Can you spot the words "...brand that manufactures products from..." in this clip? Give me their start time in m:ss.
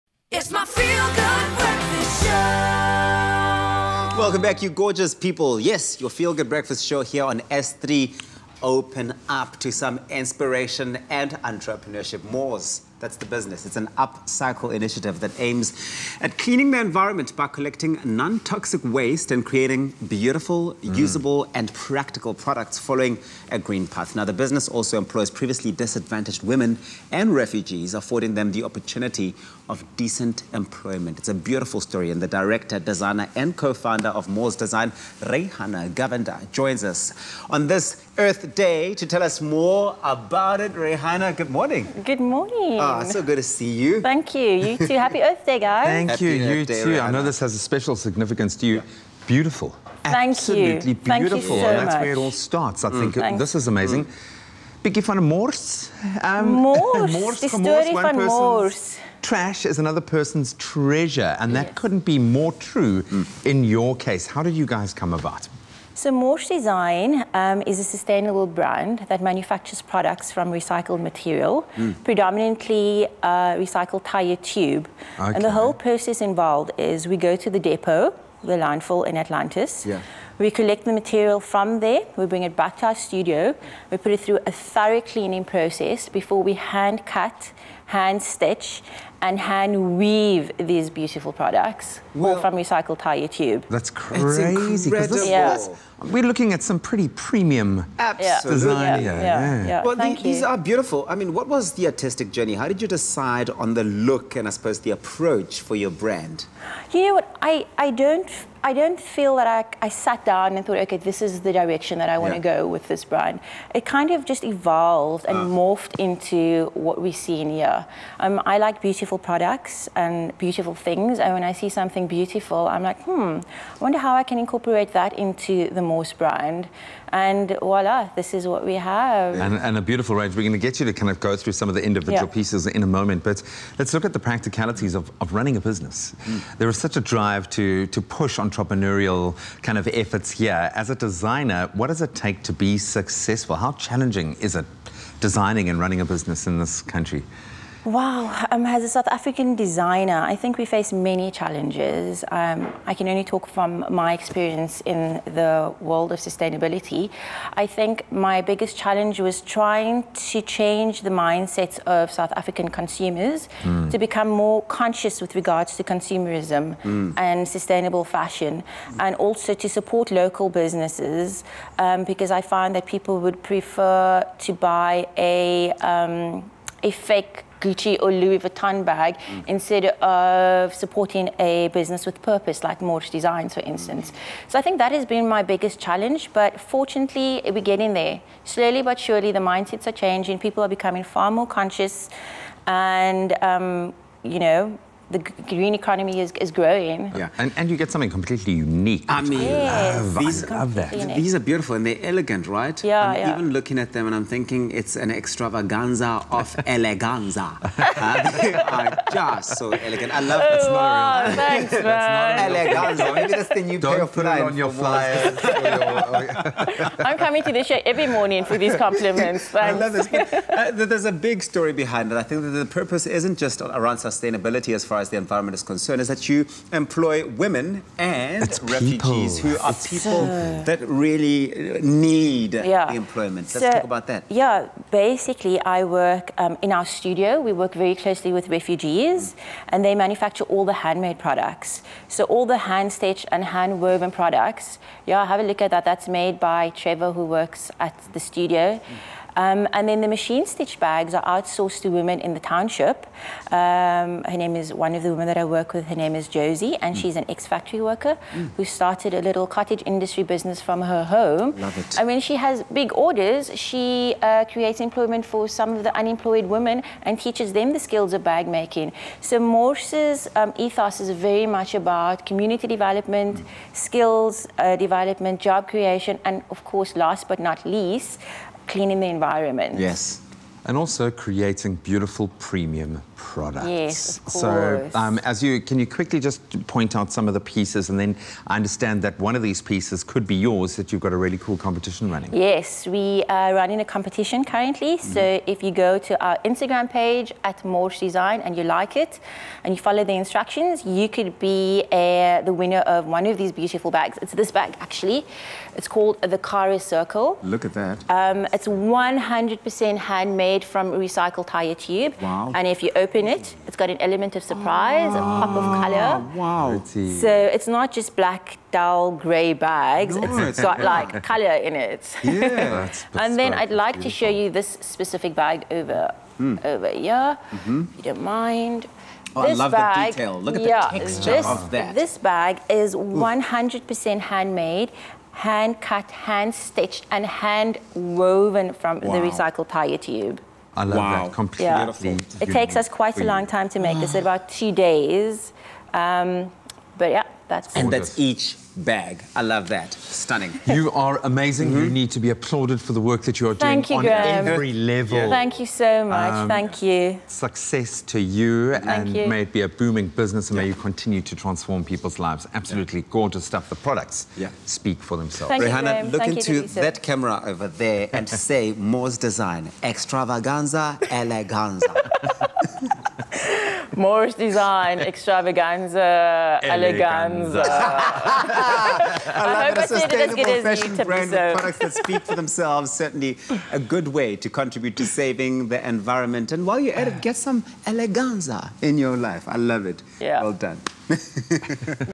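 1:08.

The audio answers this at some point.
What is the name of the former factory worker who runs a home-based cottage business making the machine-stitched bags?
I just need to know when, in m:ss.
4:16.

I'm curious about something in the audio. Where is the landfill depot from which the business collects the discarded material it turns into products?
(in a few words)
Atlantis.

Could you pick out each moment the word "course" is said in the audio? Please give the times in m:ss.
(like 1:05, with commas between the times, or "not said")
4:36, 4:44.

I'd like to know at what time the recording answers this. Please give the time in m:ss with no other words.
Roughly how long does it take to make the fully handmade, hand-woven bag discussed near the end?
5:44.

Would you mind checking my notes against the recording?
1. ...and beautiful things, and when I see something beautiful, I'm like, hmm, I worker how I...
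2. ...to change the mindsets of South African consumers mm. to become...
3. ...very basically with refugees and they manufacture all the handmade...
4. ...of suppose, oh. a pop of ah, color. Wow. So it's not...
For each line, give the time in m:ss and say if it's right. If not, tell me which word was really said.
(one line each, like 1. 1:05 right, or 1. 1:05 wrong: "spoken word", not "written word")
1. 1:59 wrong: "wonder", not "worker"
2. 2:40 right
3. 3:57 wrong: "closely", not "basically"
4. 5:14 wrong: "surprise", not "suppose".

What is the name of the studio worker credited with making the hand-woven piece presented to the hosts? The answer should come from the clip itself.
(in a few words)
Trevor.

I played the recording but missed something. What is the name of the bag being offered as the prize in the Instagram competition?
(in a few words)
Kara Circle.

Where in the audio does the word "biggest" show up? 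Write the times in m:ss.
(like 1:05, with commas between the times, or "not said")
2:38, 3:05.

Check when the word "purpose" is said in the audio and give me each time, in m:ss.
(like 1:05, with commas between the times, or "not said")
3:02, 3:42.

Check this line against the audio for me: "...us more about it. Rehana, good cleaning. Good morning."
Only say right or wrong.
wrong.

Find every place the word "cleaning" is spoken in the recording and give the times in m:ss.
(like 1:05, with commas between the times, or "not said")
0:16, 1:25, 4:38.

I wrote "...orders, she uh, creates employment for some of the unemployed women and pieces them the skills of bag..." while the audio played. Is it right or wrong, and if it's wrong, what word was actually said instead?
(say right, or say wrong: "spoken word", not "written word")
wrong: "teaches", not "pieces".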